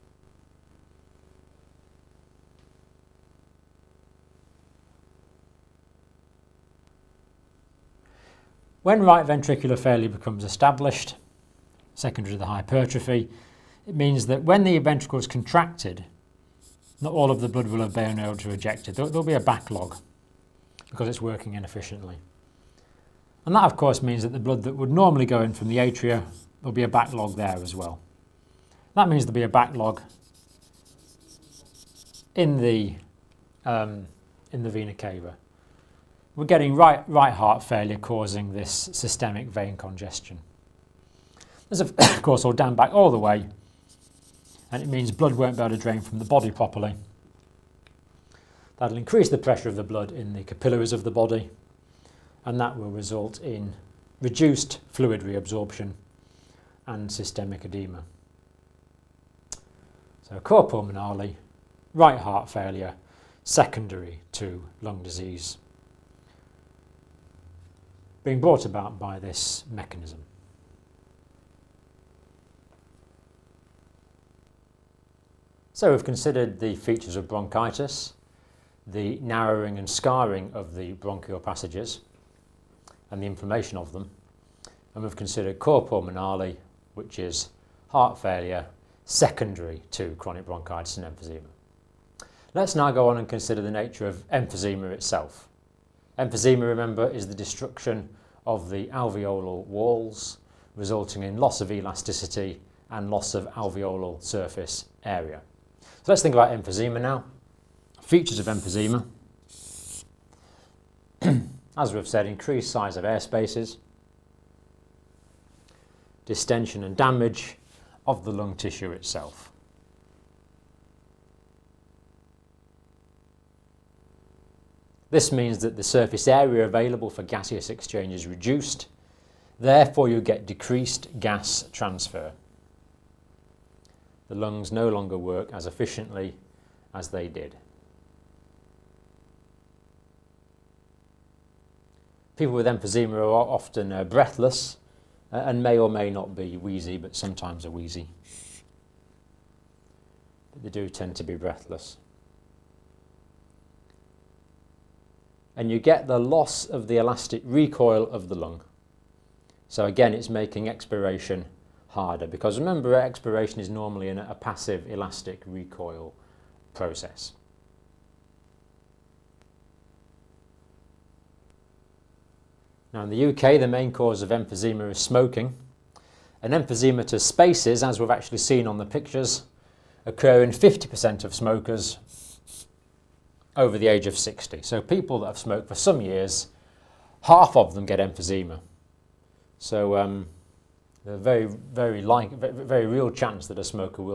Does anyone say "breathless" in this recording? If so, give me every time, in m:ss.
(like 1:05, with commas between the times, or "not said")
2:24, 2:31.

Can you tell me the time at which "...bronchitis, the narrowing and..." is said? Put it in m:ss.
1:17.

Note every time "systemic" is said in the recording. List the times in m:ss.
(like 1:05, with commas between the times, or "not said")
0:38, 0:57.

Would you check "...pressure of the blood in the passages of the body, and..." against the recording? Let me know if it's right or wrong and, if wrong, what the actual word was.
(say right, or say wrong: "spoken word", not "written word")
wrong: "capillaries", not "passages".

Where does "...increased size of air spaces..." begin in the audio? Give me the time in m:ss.
1:52.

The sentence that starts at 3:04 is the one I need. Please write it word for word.
So people that have smoked for some years, half of them get emphysema.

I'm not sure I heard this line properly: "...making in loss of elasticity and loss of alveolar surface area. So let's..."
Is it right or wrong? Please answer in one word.
wrong.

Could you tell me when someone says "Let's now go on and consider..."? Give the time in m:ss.
1:32.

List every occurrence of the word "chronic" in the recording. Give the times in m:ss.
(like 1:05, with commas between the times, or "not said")
1:30.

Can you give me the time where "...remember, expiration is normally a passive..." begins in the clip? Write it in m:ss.
2:42.